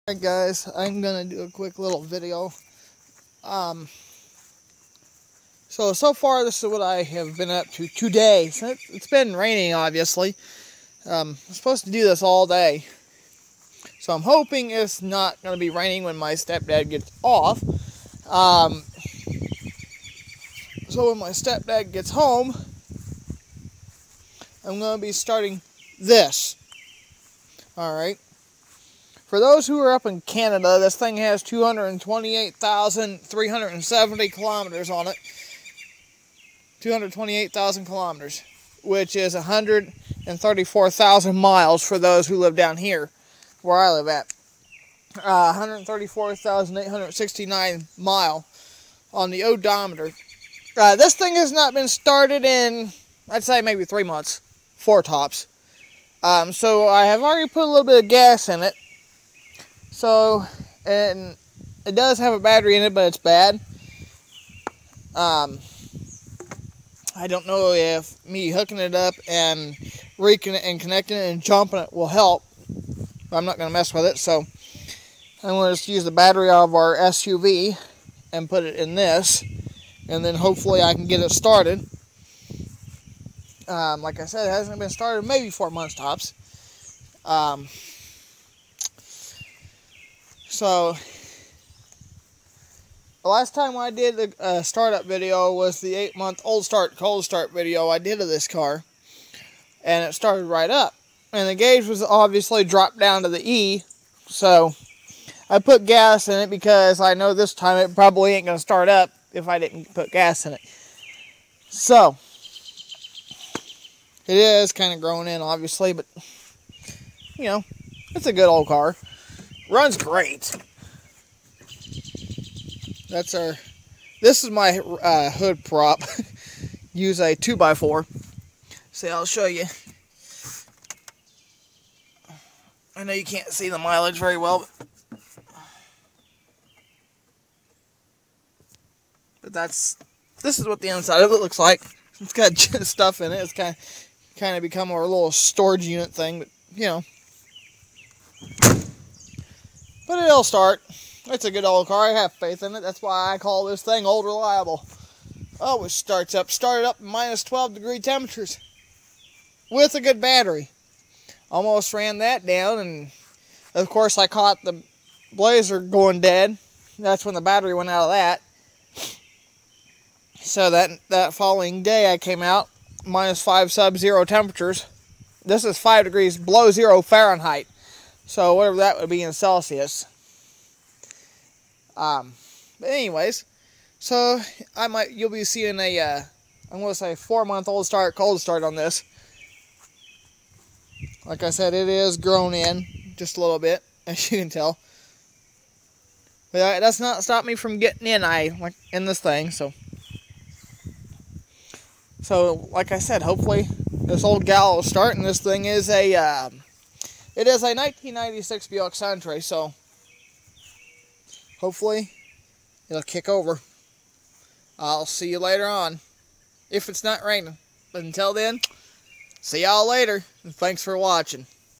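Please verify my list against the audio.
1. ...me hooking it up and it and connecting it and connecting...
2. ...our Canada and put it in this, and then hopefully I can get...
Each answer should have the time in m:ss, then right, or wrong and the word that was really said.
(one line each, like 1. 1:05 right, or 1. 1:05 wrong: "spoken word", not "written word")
1. 1:08 wrong: "jumping", not "connecting"
2. 1:16 wrong: "SUV", not "Canada".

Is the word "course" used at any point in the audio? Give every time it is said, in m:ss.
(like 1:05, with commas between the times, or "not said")
2:43.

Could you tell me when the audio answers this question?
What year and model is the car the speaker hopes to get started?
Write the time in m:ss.
3:27.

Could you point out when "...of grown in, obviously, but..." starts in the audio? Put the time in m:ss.
1:54.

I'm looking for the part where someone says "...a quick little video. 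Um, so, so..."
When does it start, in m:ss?
0:01.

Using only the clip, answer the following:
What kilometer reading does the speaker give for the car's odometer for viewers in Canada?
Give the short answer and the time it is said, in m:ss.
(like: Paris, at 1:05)
228,370, at 0:31.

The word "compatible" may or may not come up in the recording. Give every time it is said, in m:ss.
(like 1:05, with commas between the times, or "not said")
not said.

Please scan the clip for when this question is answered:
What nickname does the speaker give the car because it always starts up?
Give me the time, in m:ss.
2:34.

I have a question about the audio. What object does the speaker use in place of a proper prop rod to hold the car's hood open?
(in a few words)
2x4.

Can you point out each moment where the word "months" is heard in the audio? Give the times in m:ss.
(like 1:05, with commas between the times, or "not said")
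0:54, 1:25, 1:35, 3:07.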